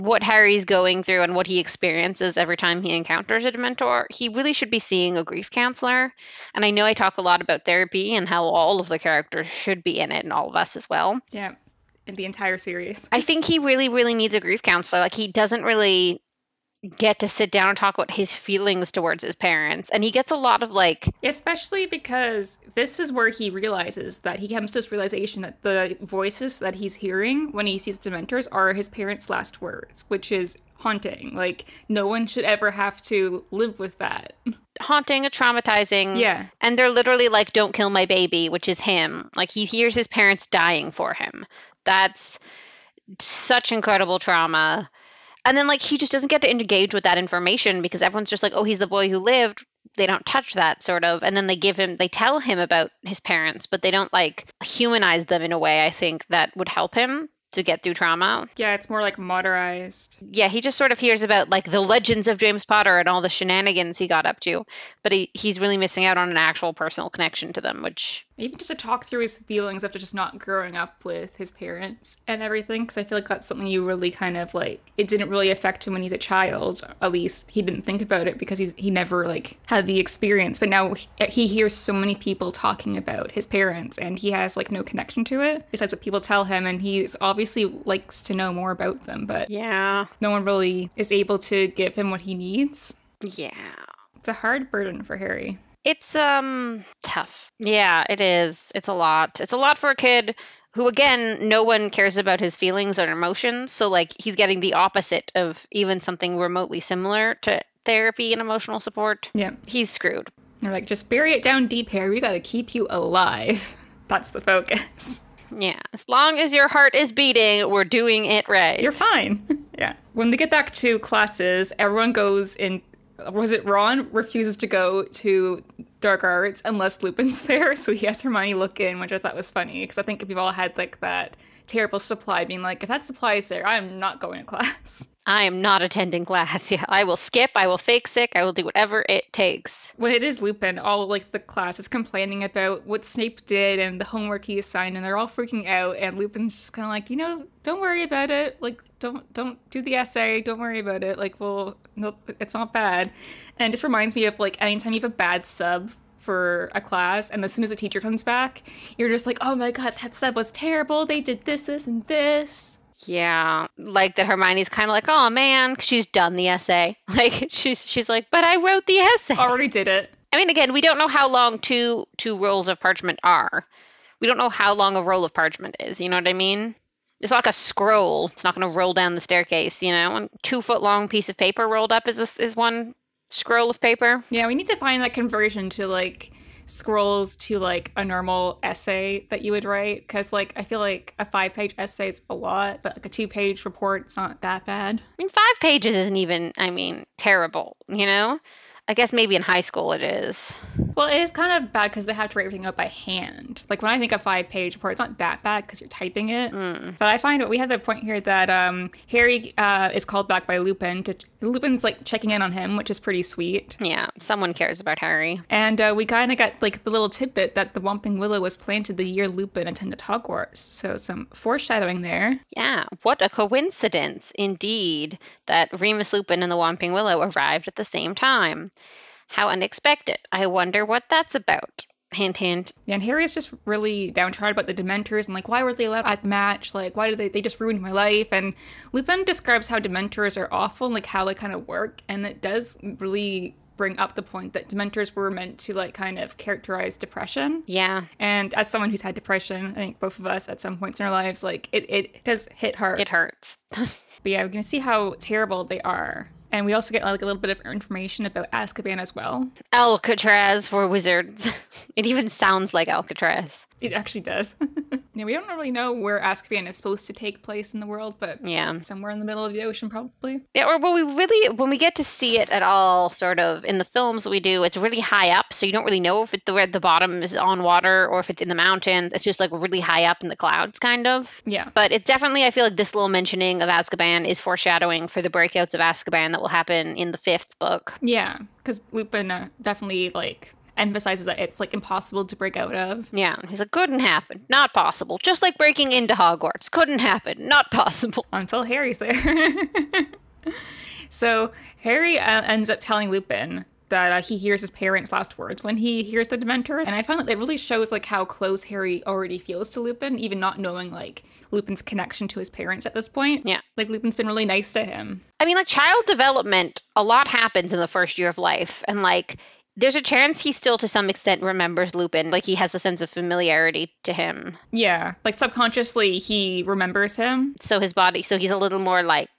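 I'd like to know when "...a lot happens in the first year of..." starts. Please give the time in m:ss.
5:16.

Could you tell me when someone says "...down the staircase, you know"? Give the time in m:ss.
2:58.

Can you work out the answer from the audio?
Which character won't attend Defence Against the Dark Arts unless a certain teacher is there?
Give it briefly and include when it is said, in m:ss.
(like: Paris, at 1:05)
Ron, at 2:03.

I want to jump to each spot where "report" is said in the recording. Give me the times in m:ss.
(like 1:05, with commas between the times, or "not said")
3:13, 3:24.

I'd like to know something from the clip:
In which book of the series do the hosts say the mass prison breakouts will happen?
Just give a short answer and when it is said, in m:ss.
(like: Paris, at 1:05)
The fifth book, at 4:47.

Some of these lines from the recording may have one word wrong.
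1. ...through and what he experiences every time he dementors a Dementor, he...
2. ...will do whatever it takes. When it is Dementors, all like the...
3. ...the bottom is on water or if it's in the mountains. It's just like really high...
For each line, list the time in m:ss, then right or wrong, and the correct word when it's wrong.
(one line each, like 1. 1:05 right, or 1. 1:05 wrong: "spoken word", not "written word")
1. 0:01 wrong: "encounters", not "dementors"
2. 2:18 wrong: "Lupin", not "Dementors"
3. 4:36 right.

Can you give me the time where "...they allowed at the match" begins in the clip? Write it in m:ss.
3:55.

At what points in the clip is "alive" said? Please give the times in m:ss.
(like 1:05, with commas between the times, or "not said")
1:52.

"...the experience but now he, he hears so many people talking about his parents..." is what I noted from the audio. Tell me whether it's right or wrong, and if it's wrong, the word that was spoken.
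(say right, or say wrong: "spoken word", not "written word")
right.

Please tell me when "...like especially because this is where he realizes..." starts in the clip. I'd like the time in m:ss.
0:20.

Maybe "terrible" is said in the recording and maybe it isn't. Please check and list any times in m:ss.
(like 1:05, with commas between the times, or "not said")
2:11, 2:40, 3:17, 4:15.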